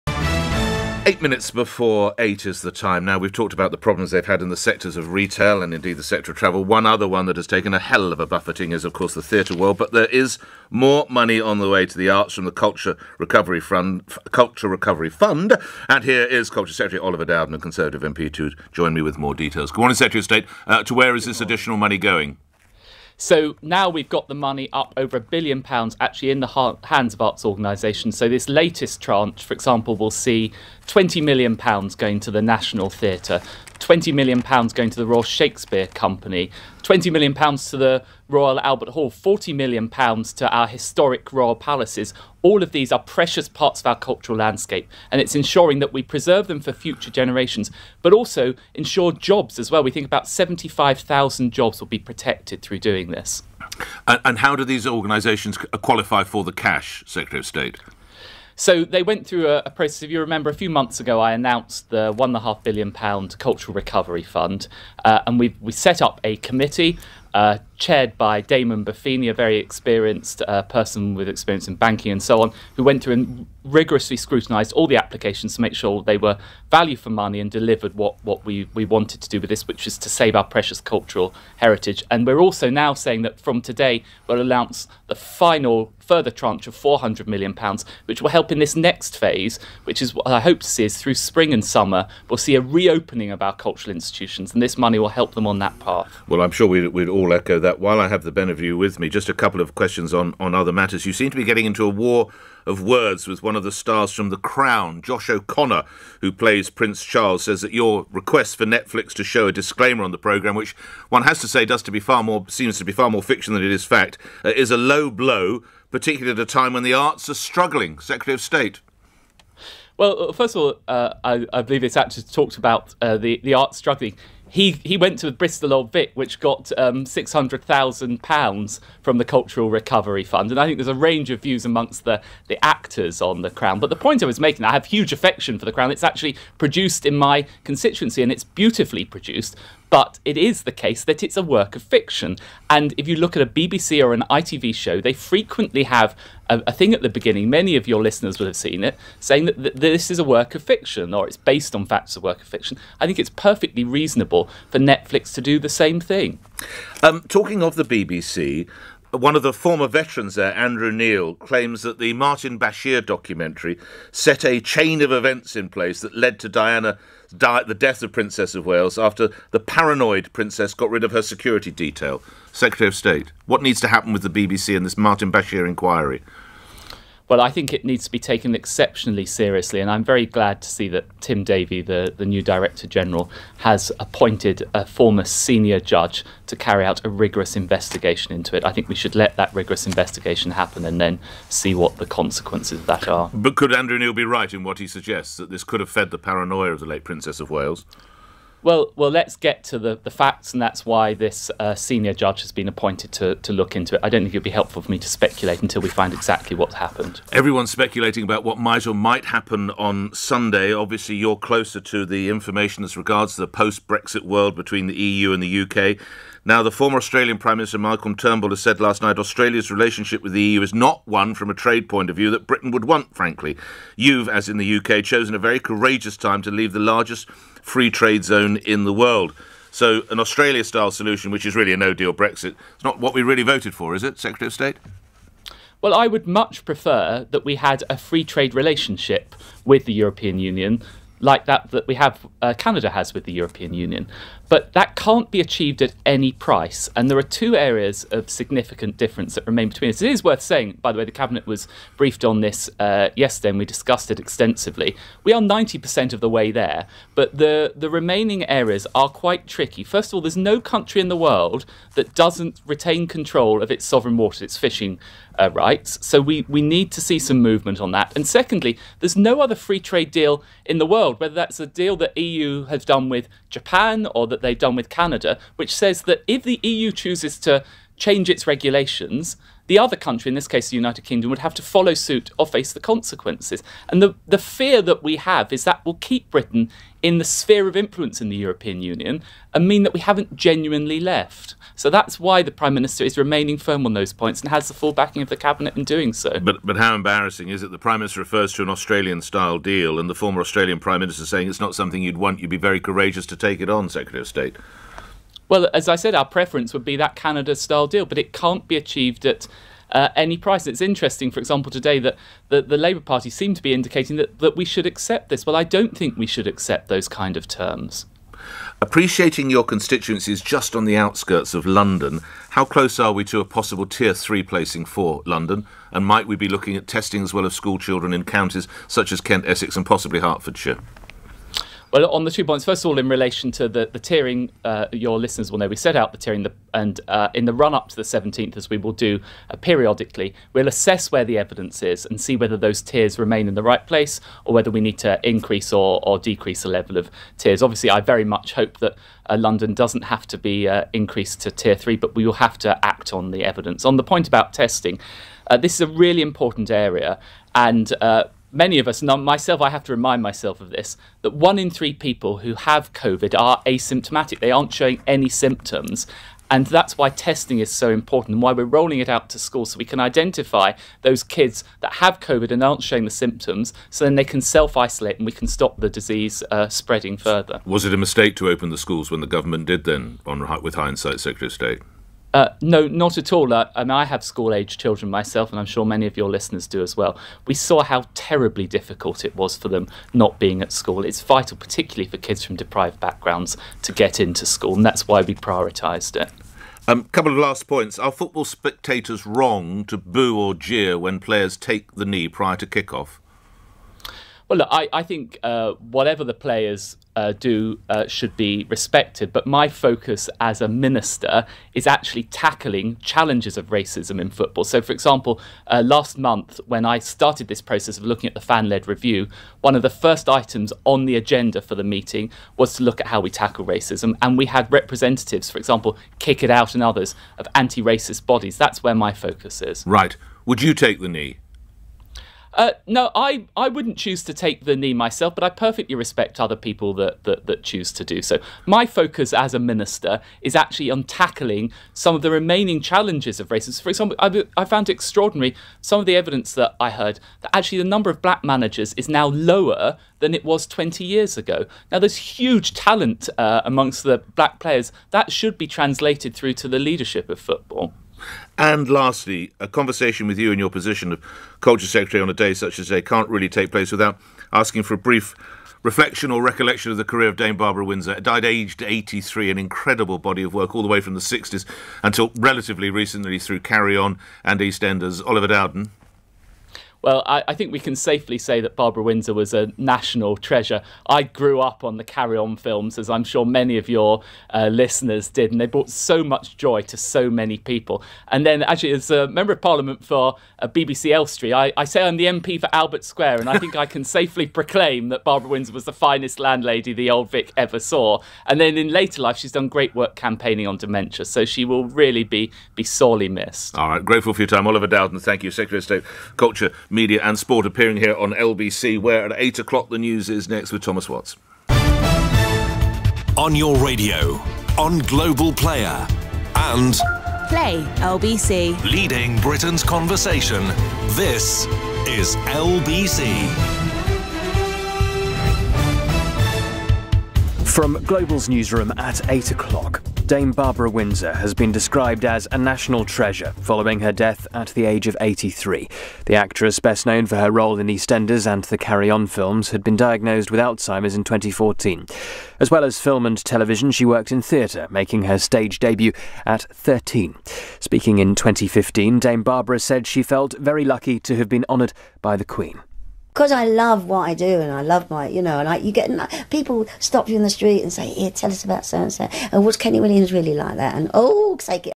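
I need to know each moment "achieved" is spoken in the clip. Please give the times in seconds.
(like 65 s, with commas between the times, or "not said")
245 s, 308 s.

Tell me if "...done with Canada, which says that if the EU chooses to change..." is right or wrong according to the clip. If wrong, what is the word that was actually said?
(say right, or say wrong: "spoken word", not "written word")
right.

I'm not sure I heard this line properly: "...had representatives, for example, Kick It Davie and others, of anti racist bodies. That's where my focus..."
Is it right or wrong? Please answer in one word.
wrong.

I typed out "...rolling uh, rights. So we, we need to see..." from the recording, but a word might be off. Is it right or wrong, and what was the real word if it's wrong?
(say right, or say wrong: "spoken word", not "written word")
wrong: "fishing", not "rolling".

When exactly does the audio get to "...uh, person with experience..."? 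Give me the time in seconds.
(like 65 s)
70 s.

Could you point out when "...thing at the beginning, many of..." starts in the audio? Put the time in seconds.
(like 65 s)
146 s.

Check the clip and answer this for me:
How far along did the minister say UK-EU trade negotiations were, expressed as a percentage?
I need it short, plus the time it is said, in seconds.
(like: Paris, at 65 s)
90%, at 255 s.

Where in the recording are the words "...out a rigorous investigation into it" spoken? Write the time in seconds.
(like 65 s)
186 s.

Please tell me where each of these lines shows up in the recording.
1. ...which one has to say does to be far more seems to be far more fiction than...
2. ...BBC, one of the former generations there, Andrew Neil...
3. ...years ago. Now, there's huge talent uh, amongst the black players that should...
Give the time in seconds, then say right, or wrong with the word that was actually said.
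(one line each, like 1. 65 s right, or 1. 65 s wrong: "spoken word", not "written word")
1. 110 s right
2. 157 s wrong: "veterans", not "generations"
3. 451 s right.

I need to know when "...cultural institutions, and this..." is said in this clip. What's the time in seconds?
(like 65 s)
93 s.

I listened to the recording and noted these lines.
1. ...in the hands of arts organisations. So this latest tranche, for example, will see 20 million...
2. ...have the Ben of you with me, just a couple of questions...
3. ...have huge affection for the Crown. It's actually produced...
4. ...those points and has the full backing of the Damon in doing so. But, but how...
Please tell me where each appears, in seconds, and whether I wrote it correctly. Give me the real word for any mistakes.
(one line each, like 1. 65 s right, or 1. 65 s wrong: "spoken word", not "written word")
1. 26 s right
2. 98 s right
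3. 134 s right
4. 293 s wrong: "Cabinet", not "Damon".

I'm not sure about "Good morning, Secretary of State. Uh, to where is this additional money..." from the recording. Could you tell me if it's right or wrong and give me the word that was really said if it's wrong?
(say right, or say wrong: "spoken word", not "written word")
right.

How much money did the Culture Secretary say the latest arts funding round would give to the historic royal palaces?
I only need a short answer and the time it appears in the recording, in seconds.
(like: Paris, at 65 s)
40 million pounds, at 39 s.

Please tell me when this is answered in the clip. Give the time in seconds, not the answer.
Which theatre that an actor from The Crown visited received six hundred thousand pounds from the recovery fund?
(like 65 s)
125 s.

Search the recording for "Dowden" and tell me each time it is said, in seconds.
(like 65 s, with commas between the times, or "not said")
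17 s, 475 s, 504 s.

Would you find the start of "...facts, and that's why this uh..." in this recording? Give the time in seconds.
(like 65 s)
200 s.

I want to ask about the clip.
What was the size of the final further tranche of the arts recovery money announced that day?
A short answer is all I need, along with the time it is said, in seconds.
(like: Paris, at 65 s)
£400 million, at 86 s.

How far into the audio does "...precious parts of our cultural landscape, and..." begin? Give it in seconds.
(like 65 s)
42 s.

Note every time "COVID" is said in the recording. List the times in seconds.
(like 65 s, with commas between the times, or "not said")
362 s, 372 s.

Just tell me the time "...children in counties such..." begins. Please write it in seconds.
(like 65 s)
327 s.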